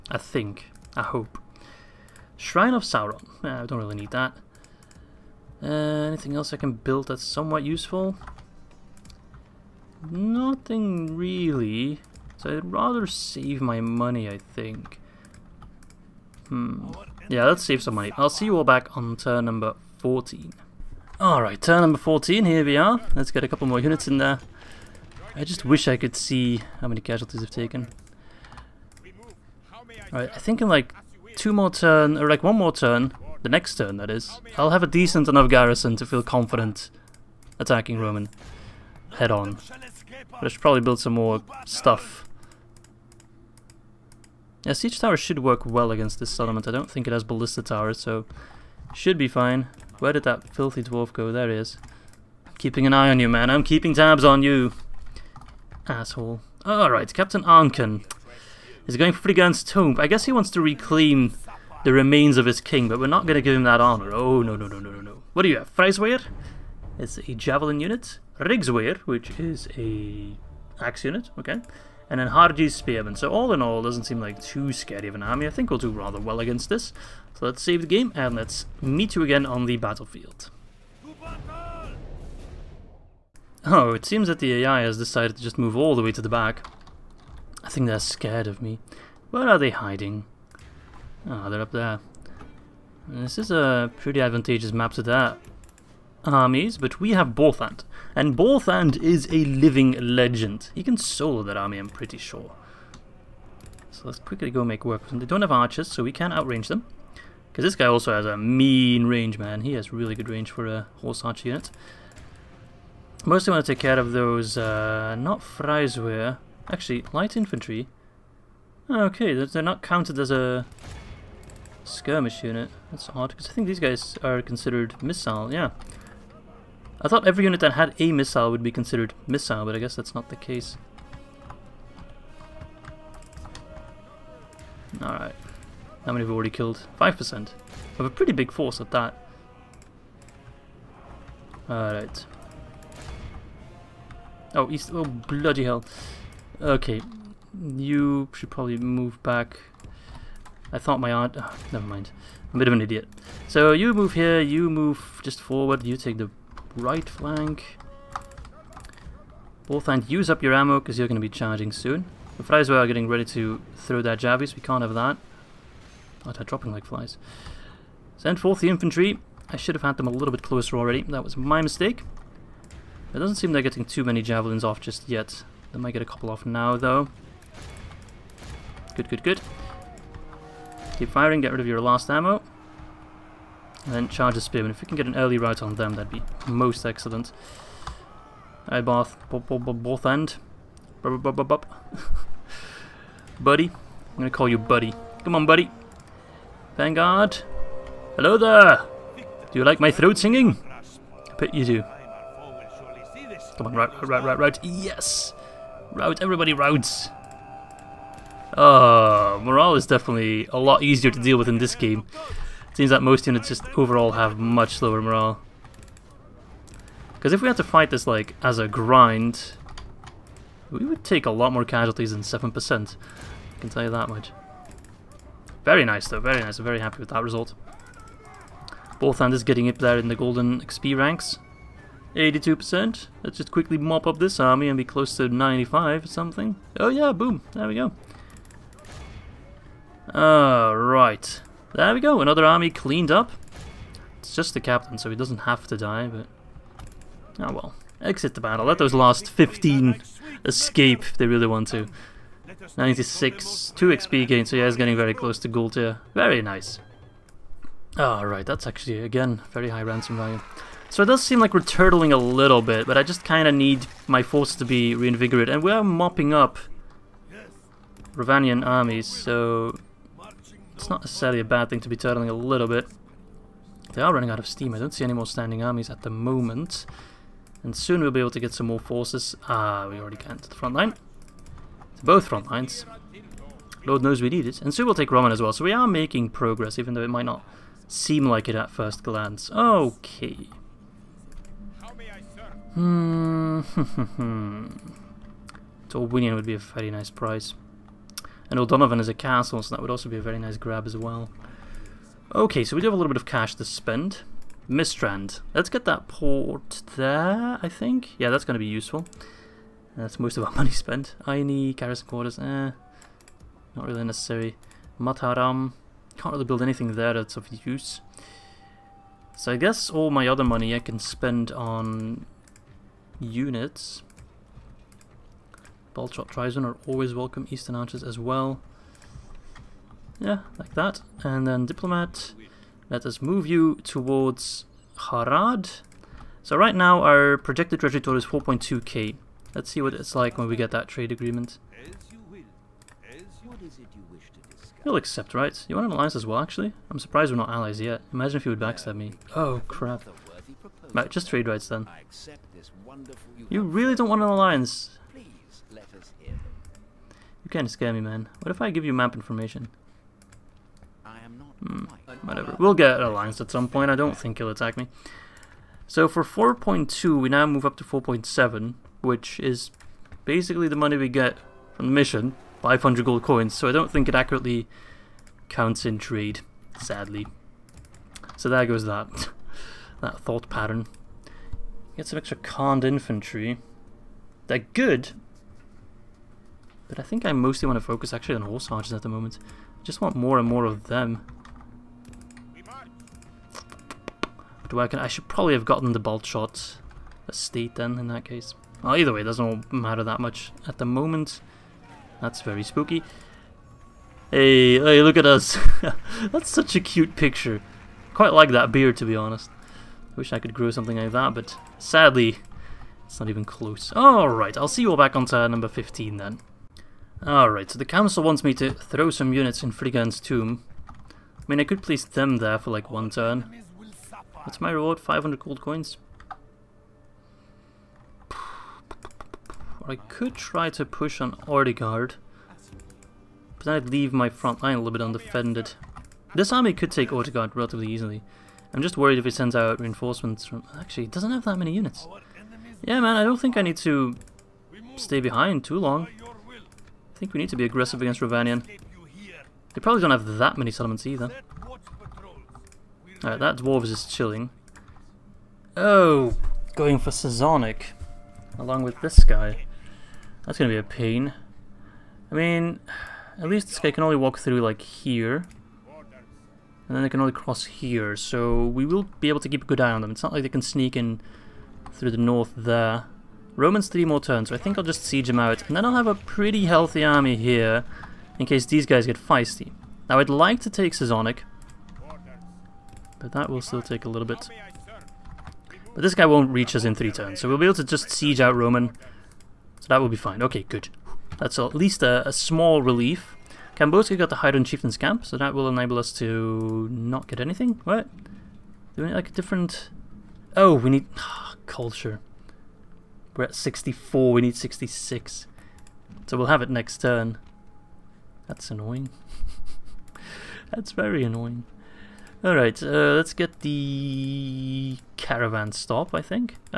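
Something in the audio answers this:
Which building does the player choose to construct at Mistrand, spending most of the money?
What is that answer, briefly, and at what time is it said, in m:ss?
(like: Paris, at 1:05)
Port, at 5:06.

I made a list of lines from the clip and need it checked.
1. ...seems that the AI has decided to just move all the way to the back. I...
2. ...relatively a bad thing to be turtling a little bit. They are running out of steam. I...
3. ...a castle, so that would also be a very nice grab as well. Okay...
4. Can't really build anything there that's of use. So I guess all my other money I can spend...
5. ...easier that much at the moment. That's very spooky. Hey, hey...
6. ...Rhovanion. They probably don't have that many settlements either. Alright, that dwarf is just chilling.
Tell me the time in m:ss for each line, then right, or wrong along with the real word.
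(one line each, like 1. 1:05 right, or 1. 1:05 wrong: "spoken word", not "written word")
1. 1:24 right
2. 4:31 wrong: "necessarily", not "relatively"
3. 4:59 right
4. 5:16 right
5. 6:39 wrong: "matter", not "easier"
6. 7:28 right.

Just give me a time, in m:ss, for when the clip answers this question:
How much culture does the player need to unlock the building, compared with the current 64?
8:24.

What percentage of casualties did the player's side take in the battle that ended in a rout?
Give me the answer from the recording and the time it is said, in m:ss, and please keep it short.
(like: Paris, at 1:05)
7%, at 3:42.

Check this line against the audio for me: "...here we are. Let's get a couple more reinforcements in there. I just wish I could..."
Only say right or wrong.
wrong.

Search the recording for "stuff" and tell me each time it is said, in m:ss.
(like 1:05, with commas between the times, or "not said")
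0:41.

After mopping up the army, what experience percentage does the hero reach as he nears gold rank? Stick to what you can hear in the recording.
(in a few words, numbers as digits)
96.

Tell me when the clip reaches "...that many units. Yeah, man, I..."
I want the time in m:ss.
7:21.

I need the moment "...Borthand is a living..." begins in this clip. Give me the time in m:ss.
1:38.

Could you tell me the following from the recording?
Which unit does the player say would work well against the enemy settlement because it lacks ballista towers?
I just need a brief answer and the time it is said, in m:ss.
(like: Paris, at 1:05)
Siege tower, at 0:44.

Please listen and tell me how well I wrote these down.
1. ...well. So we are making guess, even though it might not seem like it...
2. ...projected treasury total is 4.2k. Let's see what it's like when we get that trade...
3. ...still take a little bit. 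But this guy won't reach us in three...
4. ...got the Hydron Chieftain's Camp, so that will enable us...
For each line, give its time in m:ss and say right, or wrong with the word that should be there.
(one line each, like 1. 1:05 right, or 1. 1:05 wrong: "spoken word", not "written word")
1. 4:45 wrong: "progress", not "guess"
2. 5:37 right
3. 8:03 right
4. 8:14 right.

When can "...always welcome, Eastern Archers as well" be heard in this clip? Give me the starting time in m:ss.
5:26.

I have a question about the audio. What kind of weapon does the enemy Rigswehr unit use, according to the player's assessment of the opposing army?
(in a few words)
Axe.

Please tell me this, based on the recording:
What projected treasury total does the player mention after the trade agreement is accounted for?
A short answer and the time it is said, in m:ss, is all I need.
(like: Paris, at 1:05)
4.7k, at 6:07.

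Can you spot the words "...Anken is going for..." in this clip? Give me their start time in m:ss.
0:57.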